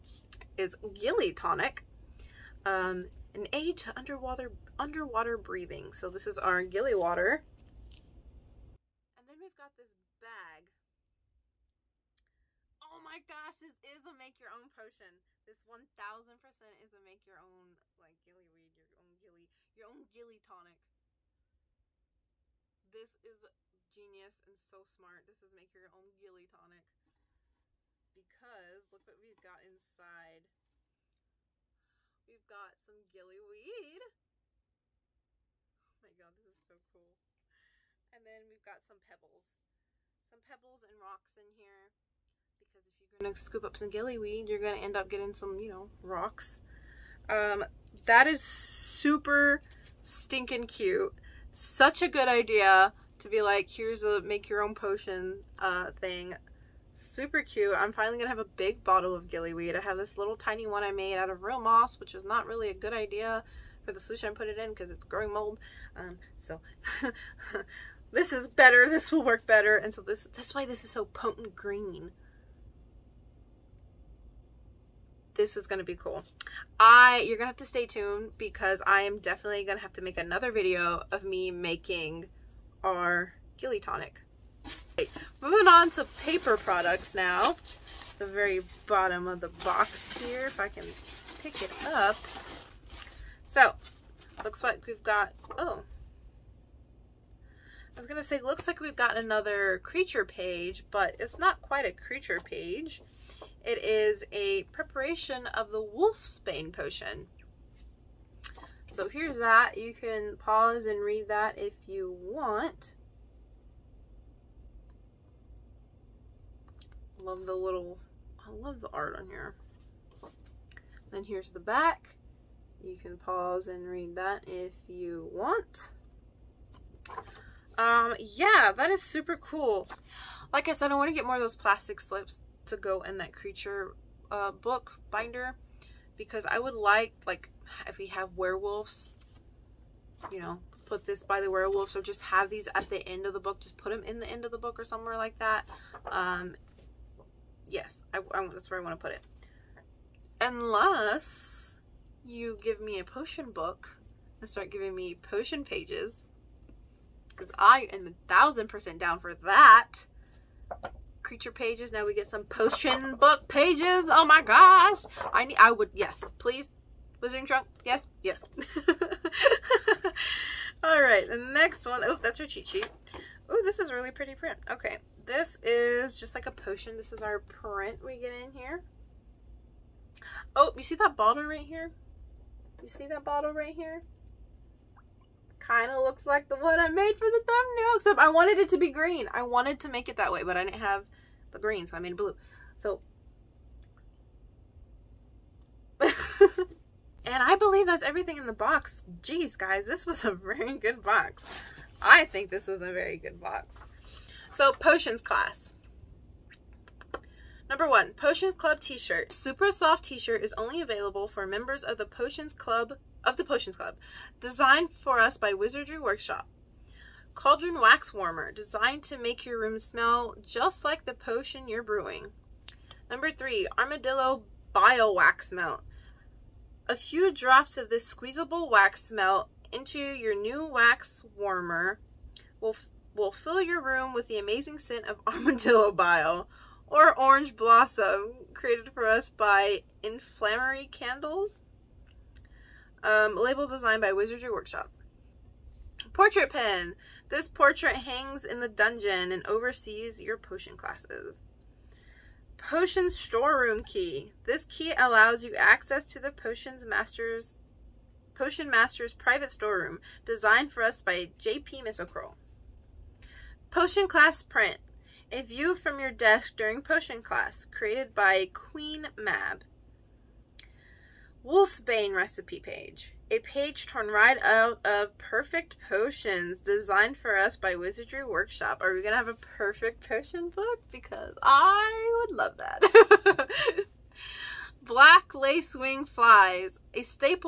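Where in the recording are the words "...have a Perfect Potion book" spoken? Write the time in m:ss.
4:39.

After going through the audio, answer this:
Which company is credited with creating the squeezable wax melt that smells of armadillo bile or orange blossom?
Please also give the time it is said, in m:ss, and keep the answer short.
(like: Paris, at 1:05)
Inflammatory Candles, at 4:00.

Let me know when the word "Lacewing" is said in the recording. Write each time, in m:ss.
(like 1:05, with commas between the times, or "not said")
4:45.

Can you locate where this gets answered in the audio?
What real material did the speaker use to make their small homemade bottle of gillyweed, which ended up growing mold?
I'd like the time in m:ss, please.
1:01.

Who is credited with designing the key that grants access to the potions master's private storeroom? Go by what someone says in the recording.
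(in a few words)
J.P. Misselcroll.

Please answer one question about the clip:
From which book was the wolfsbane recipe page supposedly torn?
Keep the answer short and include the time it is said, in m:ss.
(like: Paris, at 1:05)
Perfect Potions, at 4:35.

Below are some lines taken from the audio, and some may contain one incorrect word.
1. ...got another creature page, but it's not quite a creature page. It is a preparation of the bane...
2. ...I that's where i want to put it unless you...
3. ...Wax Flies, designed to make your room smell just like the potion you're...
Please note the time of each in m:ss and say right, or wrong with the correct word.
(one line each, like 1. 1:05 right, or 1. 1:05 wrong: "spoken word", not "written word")
1. 1:38 right
2. 2:28 right
3. 3:37 wrong: "Warmer", not "Flies".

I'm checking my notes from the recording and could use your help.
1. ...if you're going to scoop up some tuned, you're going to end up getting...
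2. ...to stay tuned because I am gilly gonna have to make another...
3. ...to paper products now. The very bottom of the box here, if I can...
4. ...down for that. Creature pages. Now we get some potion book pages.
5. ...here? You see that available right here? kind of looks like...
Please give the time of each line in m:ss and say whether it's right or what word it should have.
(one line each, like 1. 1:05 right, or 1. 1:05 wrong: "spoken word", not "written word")
1. 0:42 wrong: "gillyweed", not "tuned"
2. 1:17 wrong: "definitely", not "gilly"
3. 1:25 right
4. 2:38 right
5. 3:01 wrong: "bottle", not "available".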